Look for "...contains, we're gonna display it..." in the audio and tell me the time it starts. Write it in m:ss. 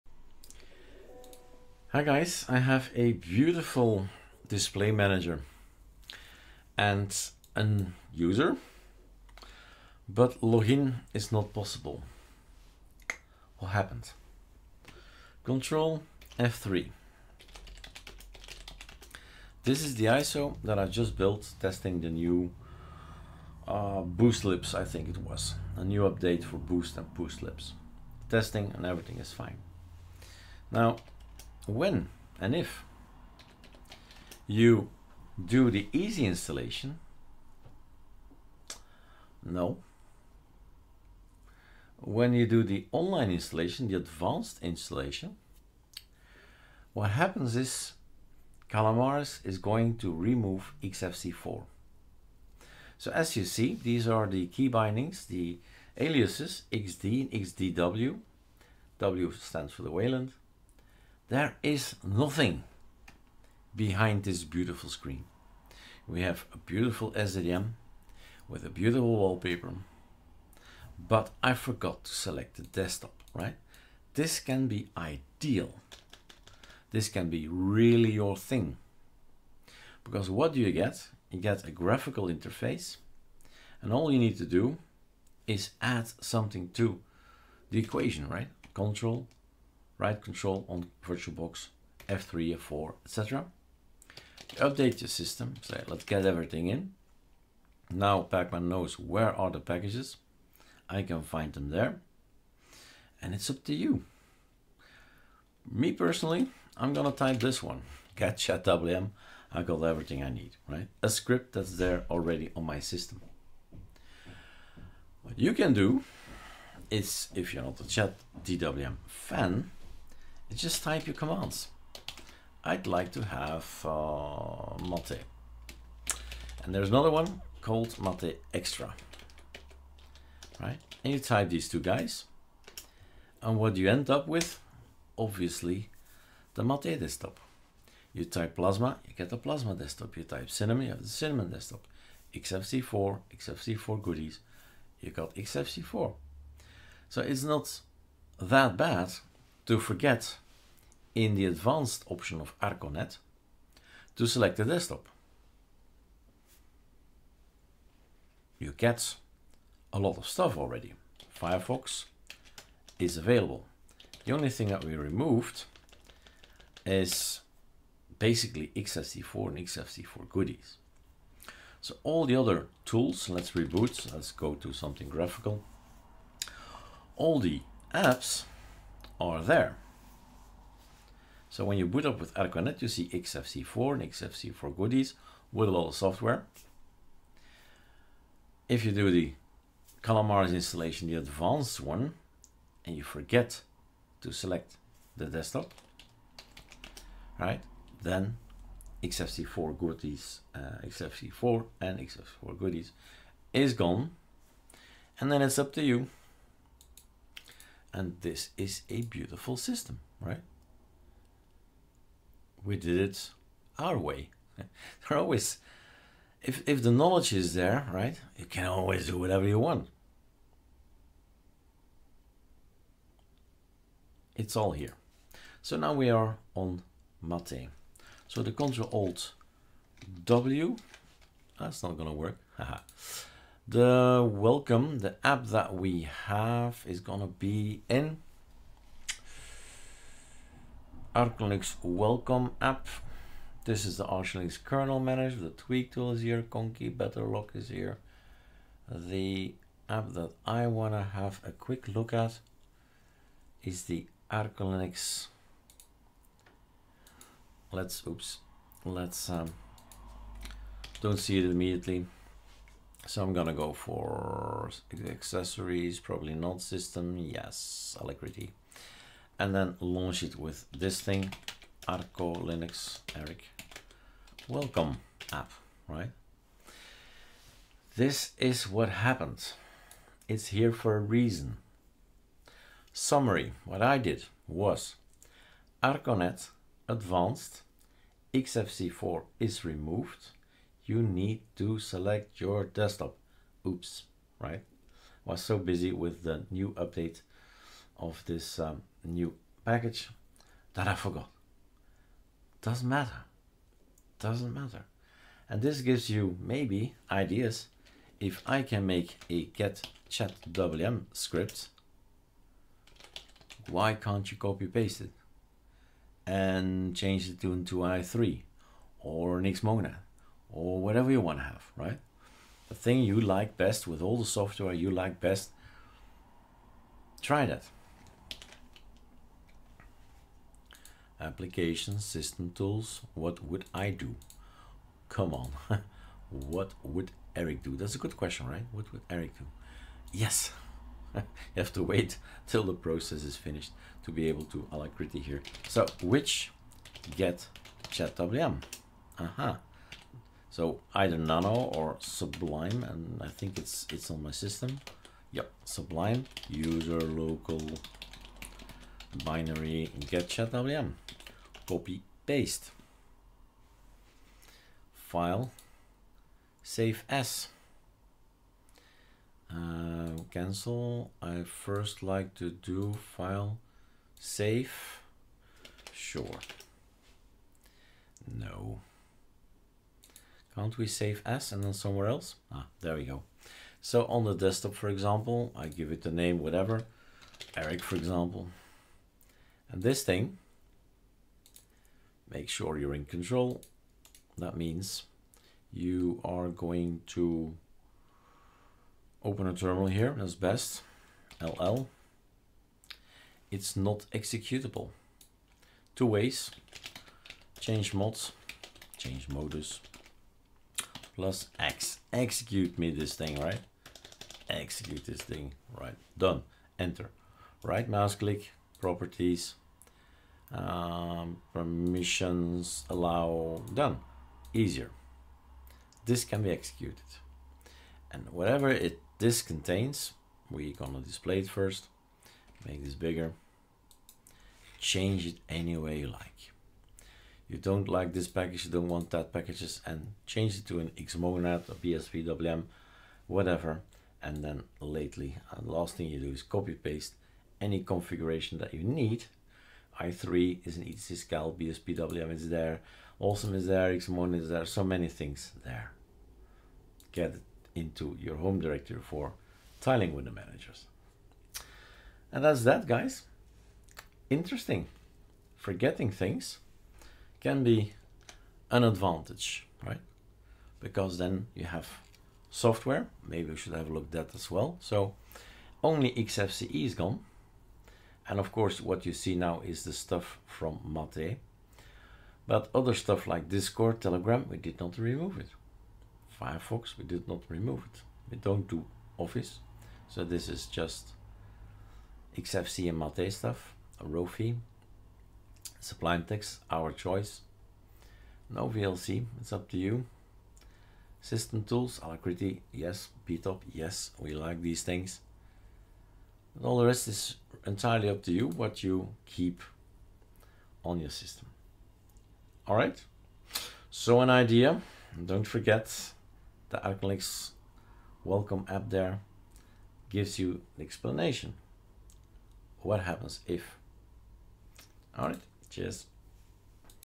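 7:09.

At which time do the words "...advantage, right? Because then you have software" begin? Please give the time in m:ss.
7:48.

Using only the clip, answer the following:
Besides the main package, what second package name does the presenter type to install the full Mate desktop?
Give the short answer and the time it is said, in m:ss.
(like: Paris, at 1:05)
mate extra, at 2:08.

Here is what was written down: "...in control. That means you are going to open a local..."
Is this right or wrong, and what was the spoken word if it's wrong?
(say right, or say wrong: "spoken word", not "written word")
wrong: "terminal", not "local".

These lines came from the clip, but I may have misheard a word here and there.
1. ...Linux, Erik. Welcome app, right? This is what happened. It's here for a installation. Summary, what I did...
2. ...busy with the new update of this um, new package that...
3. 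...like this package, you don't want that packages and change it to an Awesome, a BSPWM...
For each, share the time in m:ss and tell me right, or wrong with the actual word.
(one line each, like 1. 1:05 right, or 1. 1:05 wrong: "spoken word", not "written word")
1. 4:32 wrong: "reason", not "installation"
2. 4:55 right
3. 7:17 wrong: "Xmonad", not "Awesome".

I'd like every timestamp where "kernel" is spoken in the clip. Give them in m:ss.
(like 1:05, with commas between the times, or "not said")
4:04.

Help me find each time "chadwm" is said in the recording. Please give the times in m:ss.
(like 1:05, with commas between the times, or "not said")
1:48, 5:47, 6:00.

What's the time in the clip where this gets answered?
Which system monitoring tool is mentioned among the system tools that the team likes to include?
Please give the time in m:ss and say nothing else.
8:23.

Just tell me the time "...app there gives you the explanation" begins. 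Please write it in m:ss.
8:38.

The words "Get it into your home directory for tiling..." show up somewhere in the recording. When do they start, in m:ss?
7:37.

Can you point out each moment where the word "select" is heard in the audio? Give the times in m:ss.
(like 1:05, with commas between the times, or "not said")
1:12, 2:34, 3:14, 4:51.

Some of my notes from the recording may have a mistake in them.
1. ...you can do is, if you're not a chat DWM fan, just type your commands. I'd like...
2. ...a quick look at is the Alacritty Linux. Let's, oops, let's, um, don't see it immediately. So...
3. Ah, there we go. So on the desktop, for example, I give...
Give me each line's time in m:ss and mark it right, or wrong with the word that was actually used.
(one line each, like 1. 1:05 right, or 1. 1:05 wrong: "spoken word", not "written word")
1. 1:55 right
2. 4:11 wrong: "Arch", not "Alacritty"
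3. 6:22 right.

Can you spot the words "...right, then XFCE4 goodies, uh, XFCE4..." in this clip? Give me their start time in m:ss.
3:17.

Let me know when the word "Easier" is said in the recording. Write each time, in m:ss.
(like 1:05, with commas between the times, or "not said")
7:04.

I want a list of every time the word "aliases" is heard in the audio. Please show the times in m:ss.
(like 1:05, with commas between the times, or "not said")
0:55.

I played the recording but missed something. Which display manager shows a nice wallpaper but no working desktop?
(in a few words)
SDDM.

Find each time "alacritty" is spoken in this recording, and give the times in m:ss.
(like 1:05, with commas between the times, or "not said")
4:27, 5:44, 8:22.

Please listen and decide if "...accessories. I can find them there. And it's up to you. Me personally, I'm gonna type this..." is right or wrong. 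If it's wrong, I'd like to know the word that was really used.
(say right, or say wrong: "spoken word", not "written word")
wrong: "packages", not "accessories".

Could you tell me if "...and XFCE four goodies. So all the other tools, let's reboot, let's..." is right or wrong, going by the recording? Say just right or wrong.
right.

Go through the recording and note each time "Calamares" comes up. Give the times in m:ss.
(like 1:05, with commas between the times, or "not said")
0:48, 3:10.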